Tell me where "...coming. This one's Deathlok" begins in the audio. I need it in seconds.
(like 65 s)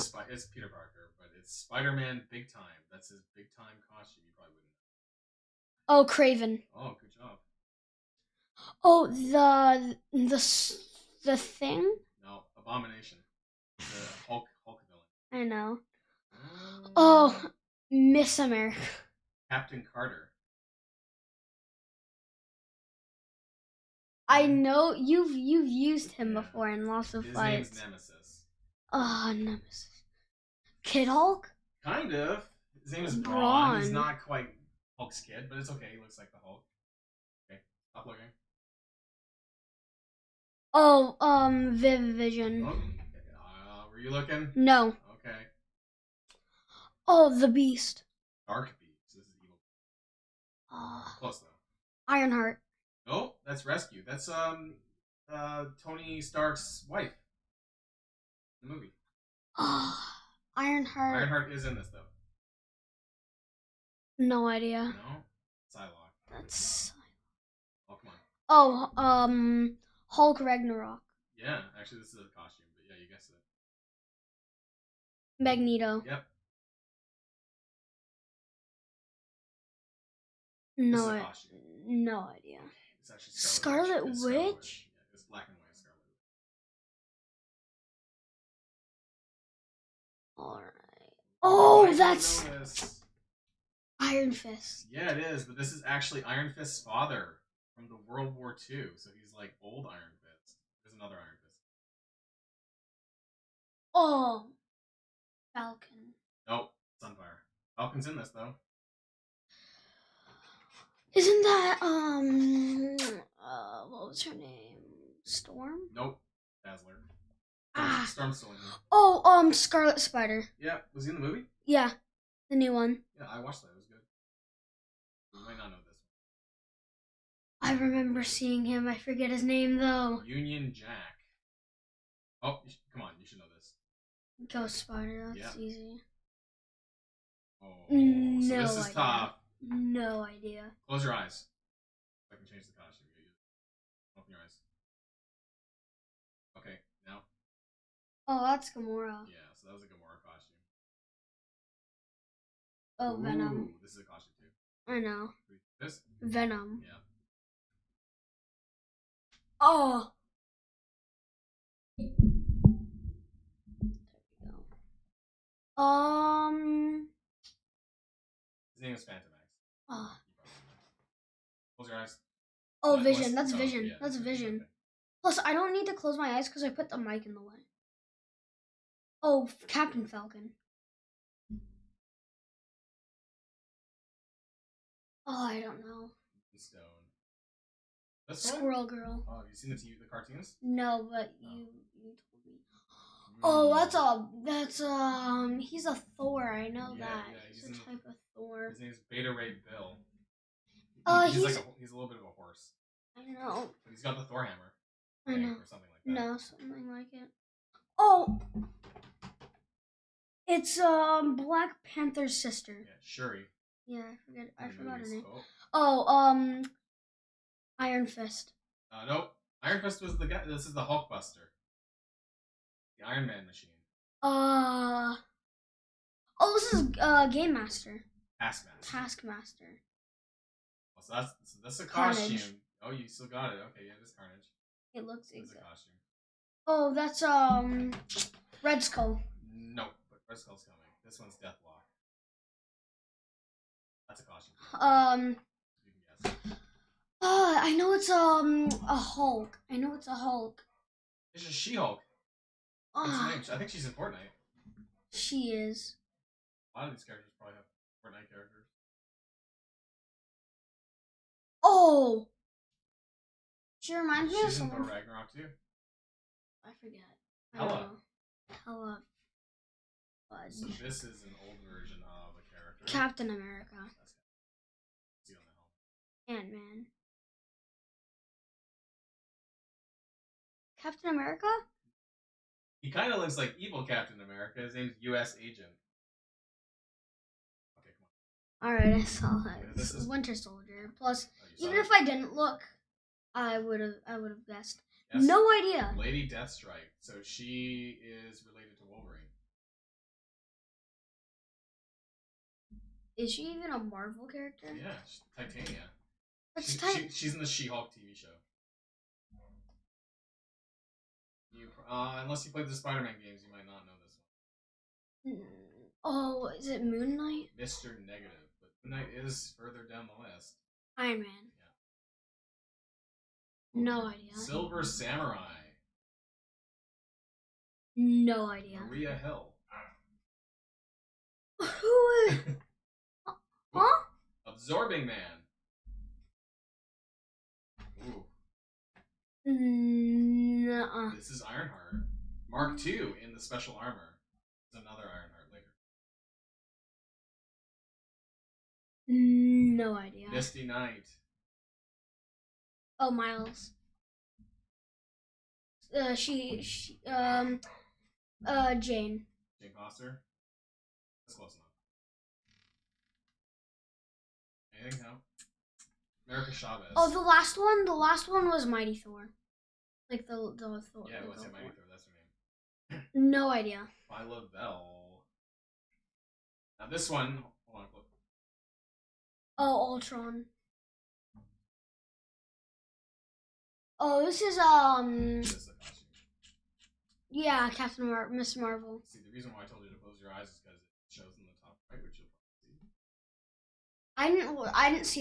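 240 s.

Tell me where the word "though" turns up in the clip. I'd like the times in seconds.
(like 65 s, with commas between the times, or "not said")
51 s, 61 s, 108 s, 129 s.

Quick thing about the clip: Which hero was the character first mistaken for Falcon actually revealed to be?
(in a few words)
Sunfire.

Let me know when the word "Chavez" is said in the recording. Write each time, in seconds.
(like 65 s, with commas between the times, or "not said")
366 s.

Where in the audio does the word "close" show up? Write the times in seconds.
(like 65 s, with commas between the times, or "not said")
51 s, 140 s, 171 s, 175 s, 389 s.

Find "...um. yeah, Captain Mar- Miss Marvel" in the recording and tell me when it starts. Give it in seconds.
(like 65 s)
384 s.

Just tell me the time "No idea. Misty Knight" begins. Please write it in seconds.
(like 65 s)
349 s.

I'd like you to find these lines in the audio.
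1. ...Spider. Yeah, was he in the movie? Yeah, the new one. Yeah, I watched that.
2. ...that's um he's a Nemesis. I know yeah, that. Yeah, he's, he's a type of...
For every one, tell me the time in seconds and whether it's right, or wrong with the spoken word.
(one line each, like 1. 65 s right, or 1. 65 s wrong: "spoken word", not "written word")
1. 119 s right
2. 194 s wrong: "Thor", not "Nemesis".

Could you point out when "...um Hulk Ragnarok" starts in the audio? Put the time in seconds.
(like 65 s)
69 s.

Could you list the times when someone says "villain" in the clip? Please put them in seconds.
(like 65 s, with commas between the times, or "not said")
14 s.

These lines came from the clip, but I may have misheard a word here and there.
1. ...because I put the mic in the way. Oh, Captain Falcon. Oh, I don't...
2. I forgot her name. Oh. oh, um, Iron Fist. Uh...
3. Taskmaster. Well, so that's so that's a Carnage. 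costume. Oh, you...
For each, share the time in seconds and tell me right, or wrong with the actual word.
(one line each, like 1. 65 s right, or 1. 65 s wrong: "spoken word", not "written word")
1. 176 s right
2. 214 s right
3. 228 s right.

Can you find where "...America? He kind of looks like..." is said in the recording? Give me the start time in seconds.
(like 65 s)
281 s.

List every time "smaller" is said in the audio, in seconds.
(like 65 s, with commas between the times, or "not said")
not said.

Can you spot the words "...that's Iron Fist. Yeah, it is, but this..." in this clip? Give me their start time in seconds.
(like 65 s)
91 s.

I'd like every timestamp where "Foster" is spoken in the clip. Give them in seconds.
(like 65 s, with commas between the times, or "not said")
359 s.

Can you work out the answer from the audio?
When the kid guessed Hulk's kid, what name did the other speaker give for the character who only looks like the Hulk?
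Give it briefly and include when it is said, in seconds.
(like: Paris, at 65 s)
Brawn, at 32 s.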